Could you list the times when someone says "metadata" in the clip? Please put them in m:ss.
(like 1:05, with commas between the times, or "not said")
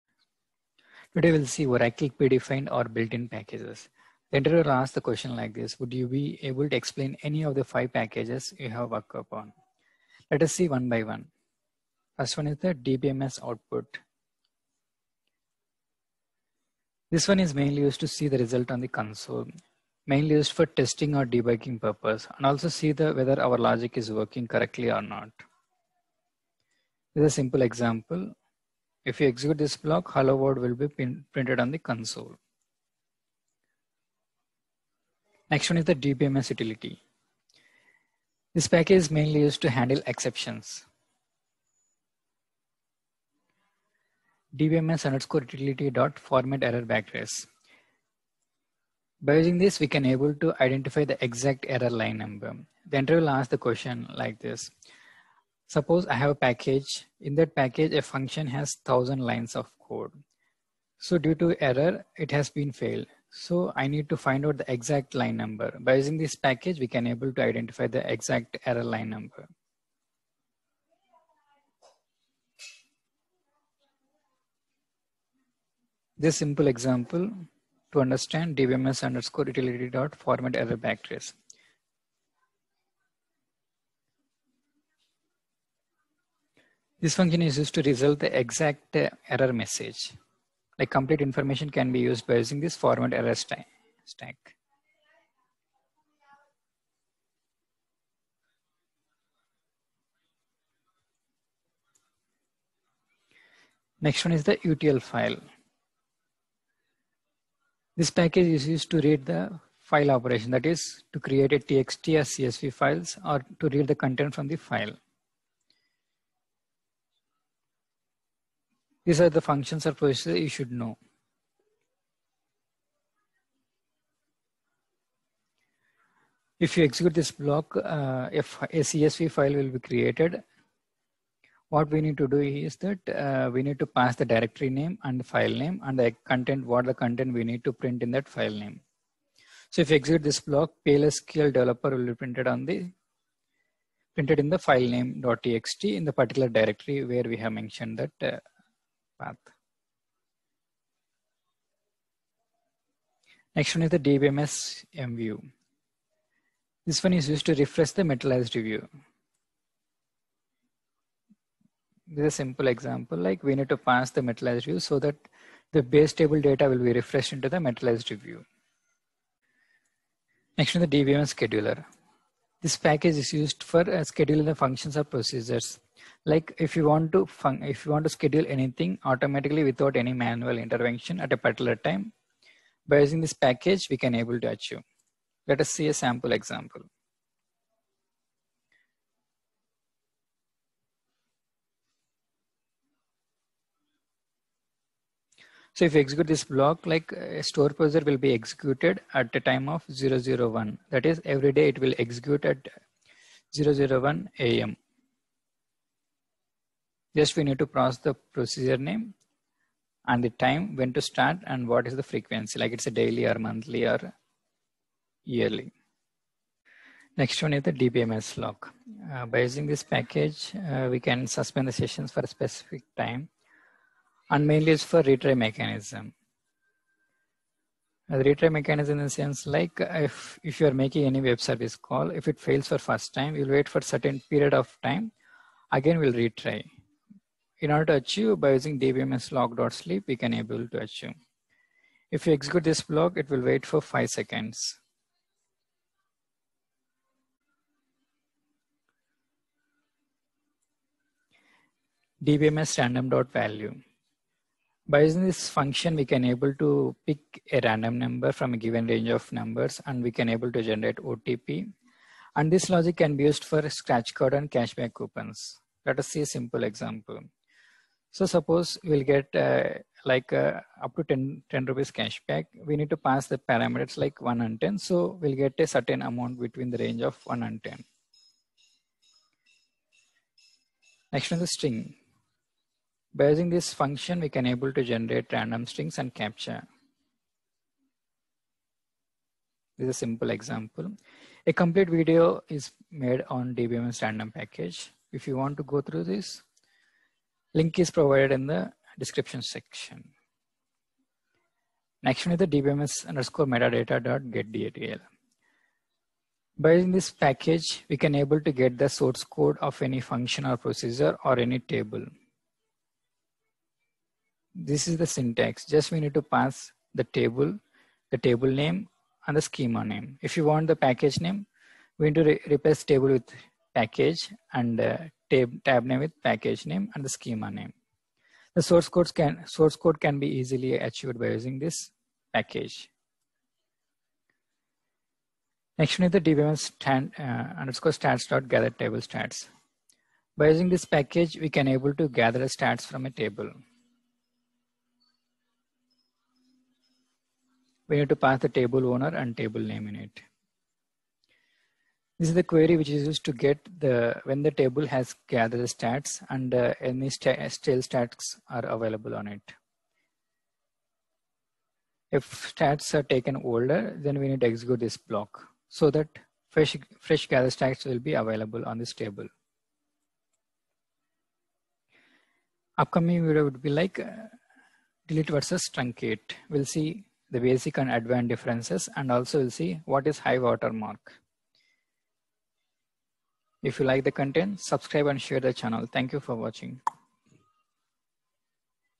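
5:03.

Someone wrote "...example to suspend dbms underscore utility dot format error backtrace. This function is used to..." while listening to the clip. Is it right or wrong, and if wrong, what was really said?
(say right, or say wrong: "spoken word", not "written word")
wrong: "understand", not "suspend".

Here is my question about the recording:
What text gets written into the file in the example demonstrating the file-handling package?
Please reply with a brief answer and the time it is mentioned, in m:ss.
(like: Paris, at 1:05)
PLSQL developer, at 2:20.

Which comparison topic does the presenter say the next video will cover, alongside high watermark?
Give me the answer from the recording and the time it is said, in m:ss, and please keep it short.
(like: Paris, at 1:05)
delete versus truncate, at 6:15.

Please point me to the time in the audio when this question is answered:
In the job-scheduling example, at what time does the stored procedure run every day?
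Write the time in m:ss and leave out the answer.
3:23.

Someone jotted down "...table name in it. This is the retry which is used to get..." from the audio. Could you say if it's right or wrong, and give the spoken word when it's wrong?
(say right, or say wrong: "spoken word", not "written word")
wrong: "query", not "retry".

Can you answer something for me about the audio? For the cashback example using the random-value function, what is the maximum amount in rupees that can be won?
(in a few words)
10 rupees.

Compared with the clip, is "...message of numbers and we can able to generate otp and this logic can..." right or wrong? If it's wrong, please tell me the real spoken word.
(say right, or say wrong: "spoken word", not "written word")
wrong: "range", not "message".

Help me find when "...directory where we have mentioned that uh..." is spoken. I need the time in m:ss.
2:26.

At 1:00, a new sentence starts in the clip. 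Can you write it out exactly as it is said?
So due to error, it has been failed.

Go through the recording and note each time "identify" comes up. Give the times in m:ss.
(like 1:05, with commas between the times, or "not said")
0:50, 1:07.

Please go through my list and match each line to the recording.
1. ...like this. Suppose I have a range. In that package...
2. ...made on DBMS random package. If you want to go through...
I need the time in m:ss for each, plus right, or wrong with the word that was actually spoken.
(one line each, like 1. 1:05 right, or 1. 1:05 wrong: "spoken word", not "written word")
1. 0:54 wrong: "package", not "range"
2. 4:52 right.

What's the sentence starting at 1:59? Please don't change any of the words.
These are the functions or procedures you should know.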